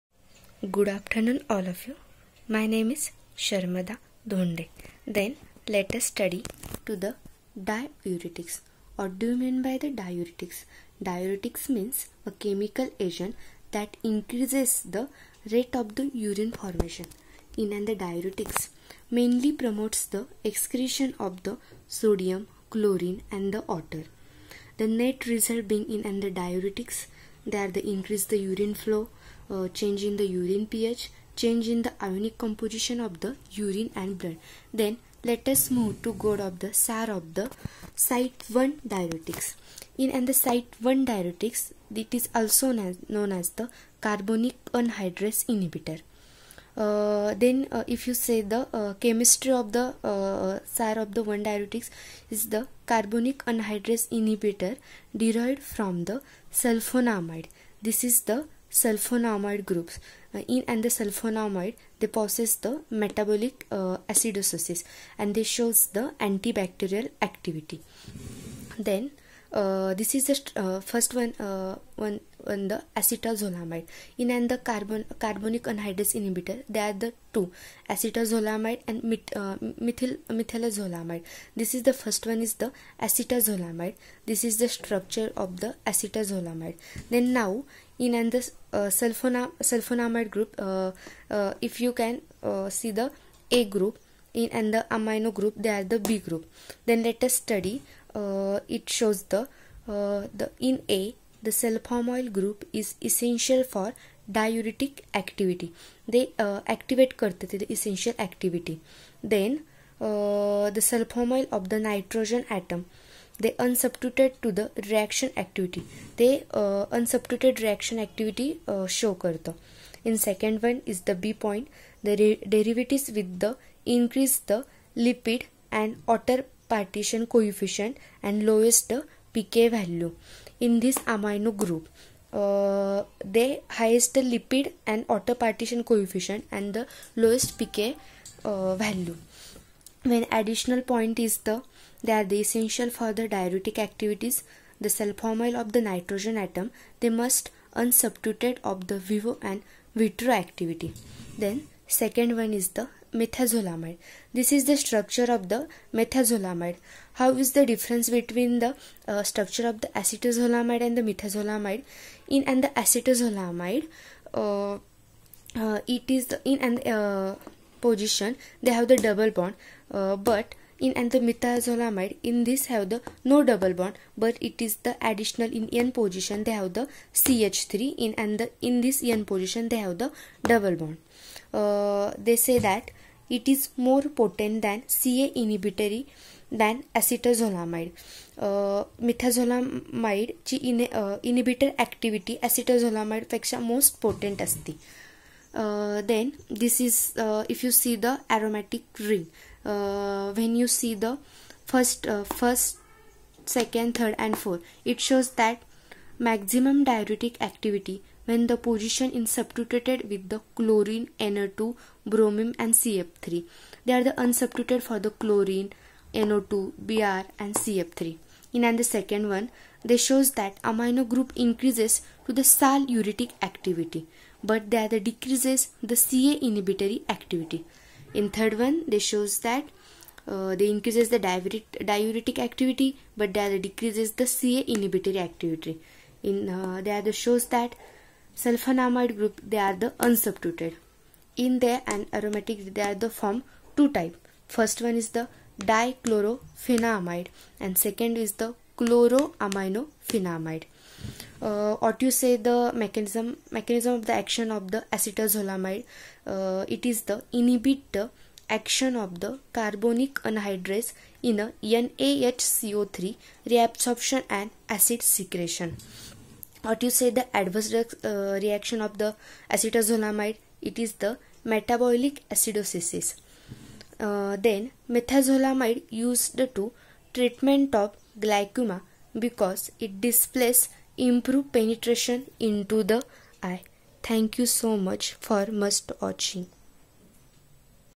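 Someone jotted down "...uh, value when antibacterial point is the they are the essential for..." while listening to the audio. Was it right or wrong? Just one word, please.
wrong.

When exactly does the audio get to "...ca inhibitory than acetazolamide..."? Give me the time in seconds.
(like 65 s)
184 s.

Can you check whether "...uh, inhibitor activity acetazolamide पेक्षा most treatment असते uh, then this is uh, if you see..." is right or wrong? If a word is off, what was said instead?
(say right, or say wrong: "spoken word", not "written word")
wrong: "potent", not "treatment".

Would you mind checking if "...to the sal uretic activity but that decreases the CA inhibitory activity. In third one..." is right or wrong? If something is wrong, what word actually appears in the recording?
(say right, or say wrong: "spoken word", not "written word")
right.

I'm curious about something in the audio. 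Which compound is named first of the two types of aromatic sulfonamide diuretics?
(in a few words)
Dichlorophenamide.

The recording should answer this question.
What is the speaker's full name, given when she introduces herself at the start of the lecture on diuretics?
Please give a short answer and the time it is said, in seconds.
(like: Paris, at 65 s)
Sharmada Dhonde, at 3 s.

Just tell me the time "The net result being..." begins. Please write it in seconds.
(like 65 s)
24 s.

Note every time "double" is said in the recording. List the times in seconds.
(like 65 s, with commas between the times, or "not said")
168 s, 173 s, 180 s.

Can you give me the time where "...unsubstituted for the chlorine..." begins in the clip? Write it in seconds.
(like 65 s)
214 s.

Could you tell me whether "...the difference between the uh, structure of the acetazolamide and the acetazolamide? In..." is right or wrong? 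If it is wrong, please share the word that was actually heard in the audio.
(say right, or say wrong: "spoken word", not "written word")
wrong: "methazolamide", not "acetazolamide".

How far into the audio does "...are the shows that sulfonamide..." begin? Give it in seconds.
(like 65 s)
236 s.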